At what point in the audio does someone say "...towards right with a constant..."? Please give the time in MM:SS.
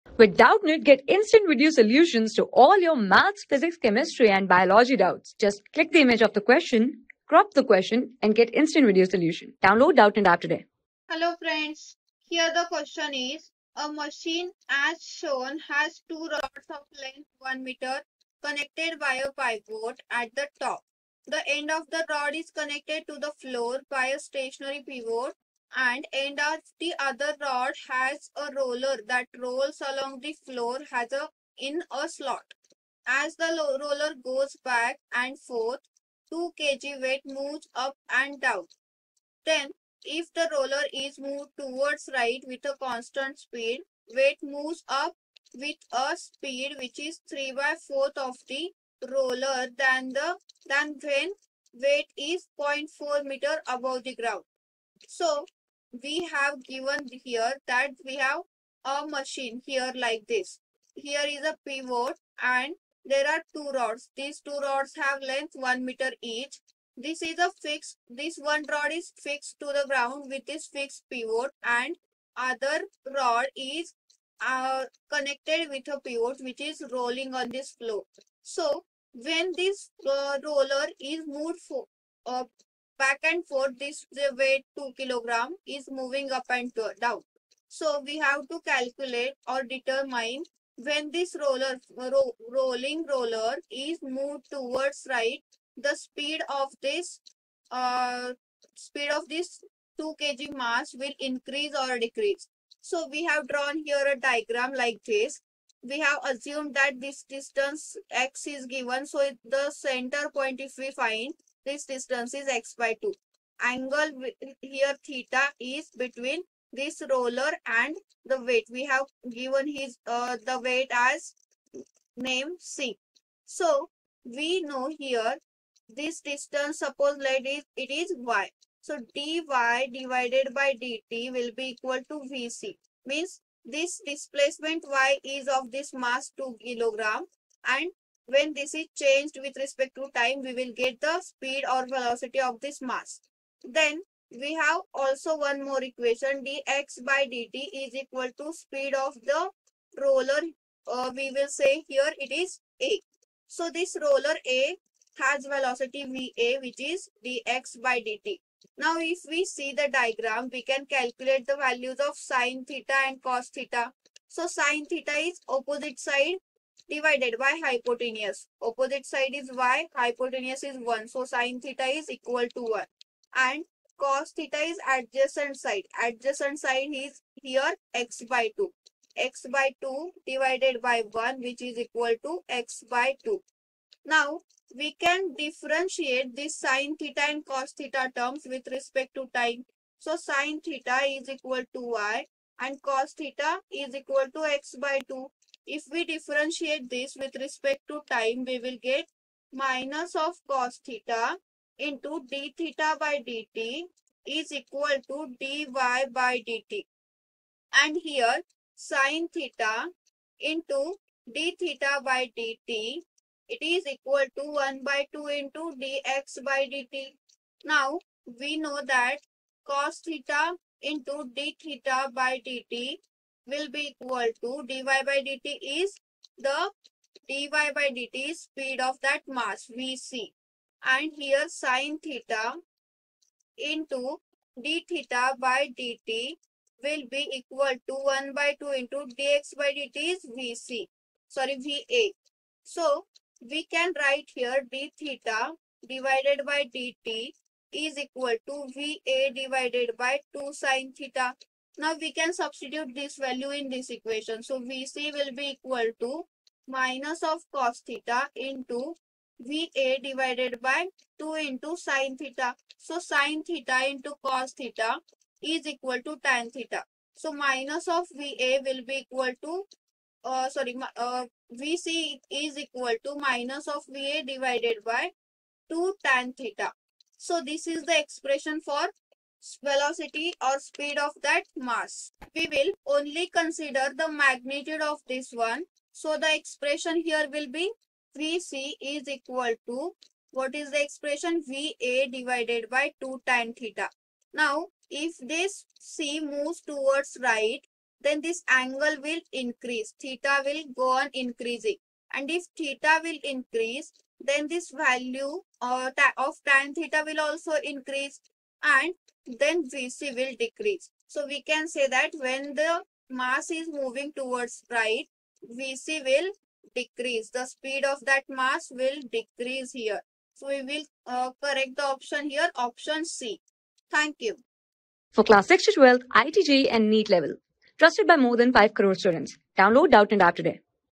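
00:41.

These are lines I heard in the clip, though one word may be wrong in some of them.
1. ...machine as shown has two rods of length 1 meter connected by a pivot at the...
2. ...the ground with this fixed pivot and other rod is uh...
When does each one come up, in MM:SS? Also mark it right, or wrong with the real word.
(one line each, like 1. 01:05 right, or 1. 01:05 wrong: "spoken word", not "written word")
1. 00:13 right
2. 01:09 right.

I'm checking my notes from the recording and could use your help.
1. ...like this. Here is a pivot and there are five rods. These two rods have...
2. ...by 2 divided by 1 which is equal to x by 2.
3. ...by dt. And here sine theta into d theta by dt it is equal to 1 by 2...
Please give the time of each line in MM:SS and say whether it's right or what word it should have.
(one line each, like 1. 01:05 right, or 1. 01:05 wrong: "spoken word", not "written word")
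1. 00:59 wrong: "two", not "five"
2. 02:59 right
3. 03:25 right.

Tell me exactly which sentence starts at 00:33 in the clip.
As the roller goes back and forth, 2 kg weight moves up and down.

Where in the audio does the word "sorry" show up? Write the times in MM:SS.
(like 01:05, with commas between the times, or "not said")
04:01, 04:30.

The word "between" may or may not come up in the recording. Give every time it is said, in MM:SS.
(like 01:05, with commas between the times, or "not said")
01:55.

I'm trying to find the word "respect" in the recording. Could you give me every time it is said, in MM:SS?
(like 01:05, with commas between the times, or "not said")
02:19, 03:08, 03:17.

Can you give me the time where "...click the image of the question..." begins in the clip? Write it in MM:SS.
00:05.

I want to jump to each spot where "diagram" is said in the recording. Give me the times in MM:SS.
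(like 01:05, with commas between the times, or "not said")
01:44, 02:39.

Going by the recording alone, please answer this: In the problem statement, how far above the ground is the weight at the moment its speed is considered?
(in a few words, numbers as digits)
0.4 meter.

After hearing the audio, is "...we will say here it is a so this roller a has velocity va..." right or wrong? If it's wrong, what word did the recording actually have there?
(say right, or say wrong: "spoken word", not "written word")
right.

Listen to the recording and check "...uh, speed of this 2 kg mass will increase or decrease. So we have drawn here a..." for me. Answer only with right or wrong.
right.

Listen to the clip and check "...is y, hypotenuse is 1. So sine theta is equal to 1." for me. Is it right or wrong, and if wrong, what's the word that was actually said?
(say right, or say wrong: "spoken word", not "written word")
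right.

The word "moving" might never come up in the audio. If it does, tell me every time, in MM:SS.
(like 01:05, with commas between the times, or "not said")
01:25, 05:13.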